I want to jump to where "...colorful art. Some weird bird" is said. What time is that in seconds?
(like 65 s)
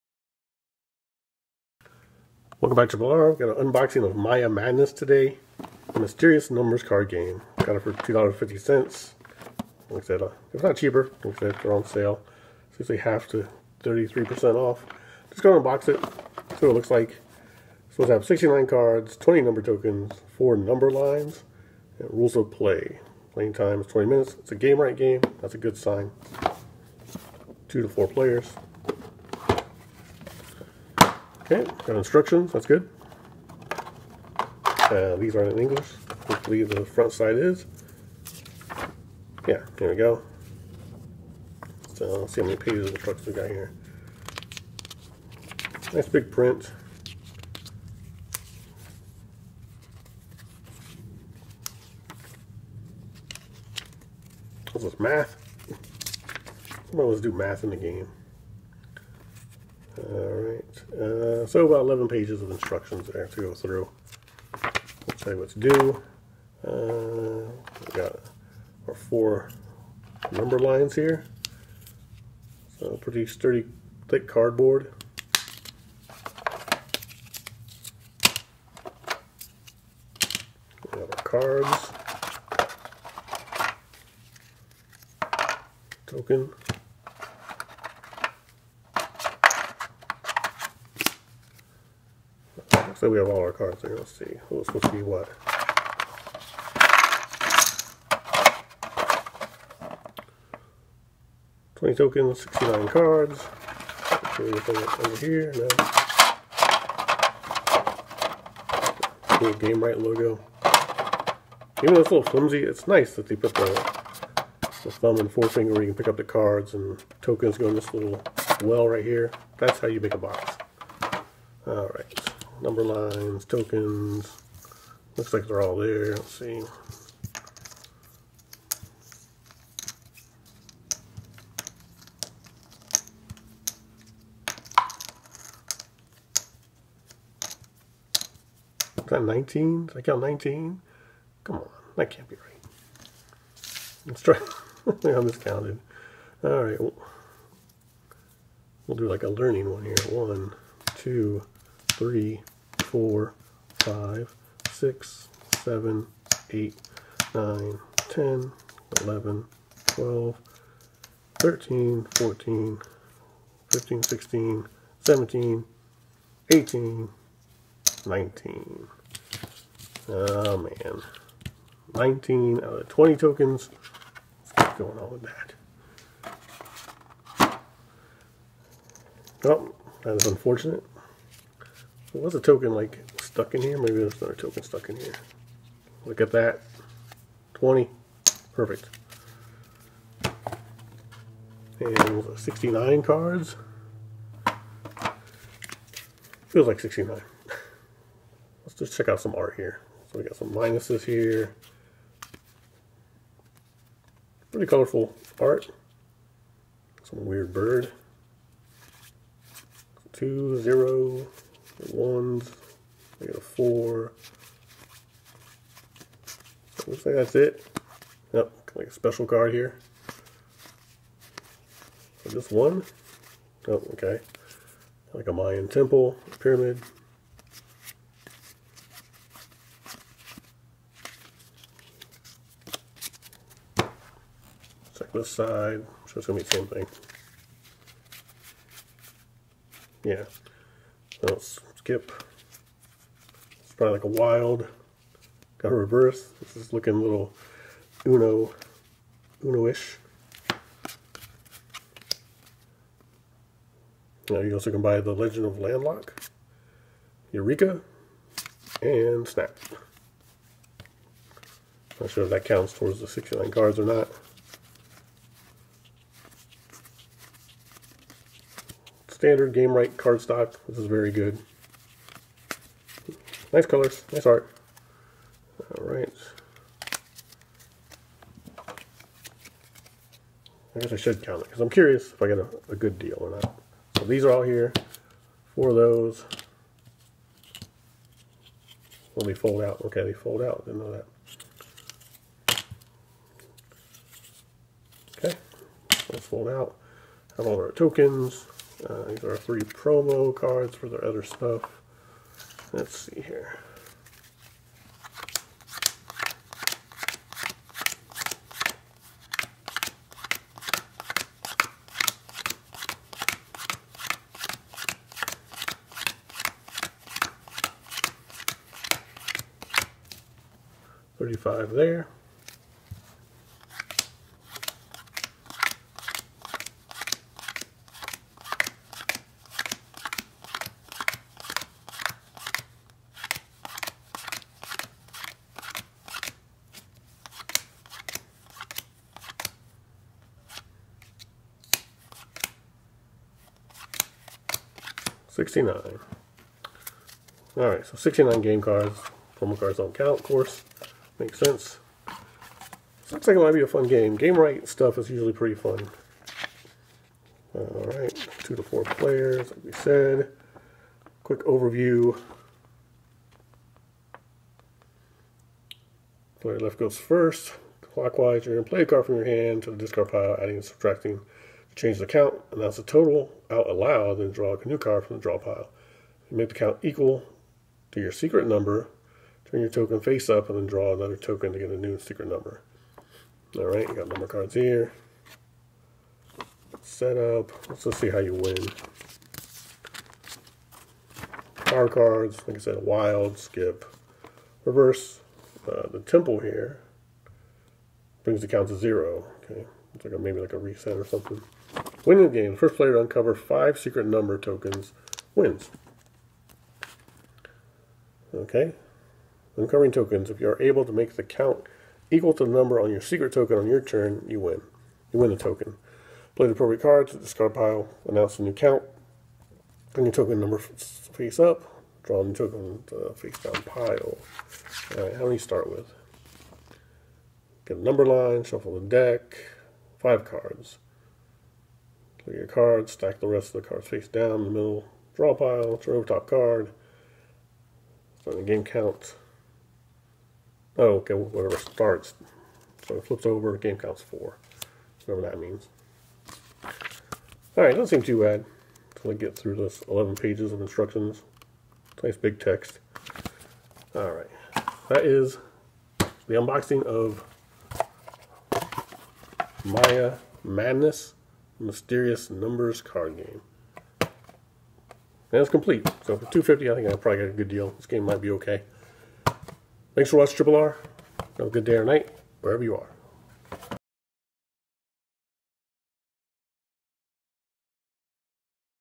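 204 s.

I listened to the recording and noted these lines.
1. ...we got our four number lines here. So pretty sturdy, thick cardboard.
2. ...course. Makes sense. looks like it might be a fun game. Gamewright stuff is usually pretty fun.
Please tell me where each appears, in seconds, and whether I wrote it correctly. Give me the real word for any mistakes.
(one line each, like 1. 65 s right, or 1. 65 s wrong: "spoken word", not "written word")
1. 67 s right
2. 350 s right.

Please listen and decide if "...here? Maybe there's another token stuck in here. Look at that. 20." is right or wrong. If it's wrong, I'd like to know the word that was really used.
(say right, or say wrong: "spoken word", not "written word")
right.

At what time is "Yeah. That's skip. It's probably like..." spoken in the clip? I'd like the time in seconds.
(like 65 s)
240 s.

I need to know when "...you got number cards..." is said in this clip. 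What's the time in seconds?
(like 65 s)
383 s.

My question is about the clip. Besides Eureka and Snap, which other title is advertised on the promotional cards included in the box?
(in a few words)
The Legend of Landlock.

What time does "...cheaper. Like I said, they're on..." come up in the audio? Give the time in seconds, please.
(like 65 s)
10 s.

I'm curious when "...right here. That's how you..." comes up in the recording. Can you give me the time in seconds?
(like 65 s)
118 s.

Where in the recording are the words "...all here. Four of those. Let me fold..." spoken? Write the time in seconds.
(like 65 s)
284 s.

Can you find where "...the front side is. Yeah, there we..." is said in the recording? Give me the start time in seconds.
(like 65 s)
36 s.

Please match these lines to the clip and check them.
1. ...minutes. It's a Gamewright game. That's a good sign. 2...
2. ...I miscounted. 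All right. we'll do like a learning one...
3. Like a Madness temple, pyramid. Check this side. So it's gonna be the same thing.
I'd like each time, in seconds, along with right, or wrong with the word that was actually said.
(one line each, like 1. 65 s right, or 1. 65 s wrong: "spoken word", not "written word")
1. 24 s right
2. 144 s right
3. 225 s wrong: "Mayan", not "Madness".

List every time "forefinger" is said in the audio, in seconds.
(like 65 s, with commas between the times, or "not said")
115 s.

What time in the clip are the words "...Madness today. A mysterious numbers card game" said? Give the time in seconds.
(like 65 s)
4 s.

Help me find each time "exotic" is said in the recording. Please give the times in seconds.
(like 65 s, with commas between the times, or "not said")
not said.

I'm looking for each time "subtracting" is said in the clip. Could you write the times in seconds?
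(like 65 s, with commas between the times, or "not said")
370 s.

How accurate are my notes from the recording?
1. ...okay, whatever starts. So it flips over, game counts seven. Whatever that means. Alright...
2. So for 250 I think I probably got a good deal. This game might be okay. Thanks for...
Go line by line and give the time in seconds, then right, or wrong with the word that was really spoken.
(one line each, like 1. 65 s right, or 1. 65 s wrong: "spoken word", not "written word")
1. 440 s wrong: "four", not "seven"
2. 466 s right.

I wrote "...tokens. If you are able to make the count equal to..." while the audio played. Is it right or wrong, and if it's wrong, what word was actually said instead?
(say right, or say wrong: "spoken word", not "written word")
right.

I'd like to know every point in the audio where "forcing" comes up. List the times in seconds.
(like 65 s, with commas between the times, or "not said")
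not said.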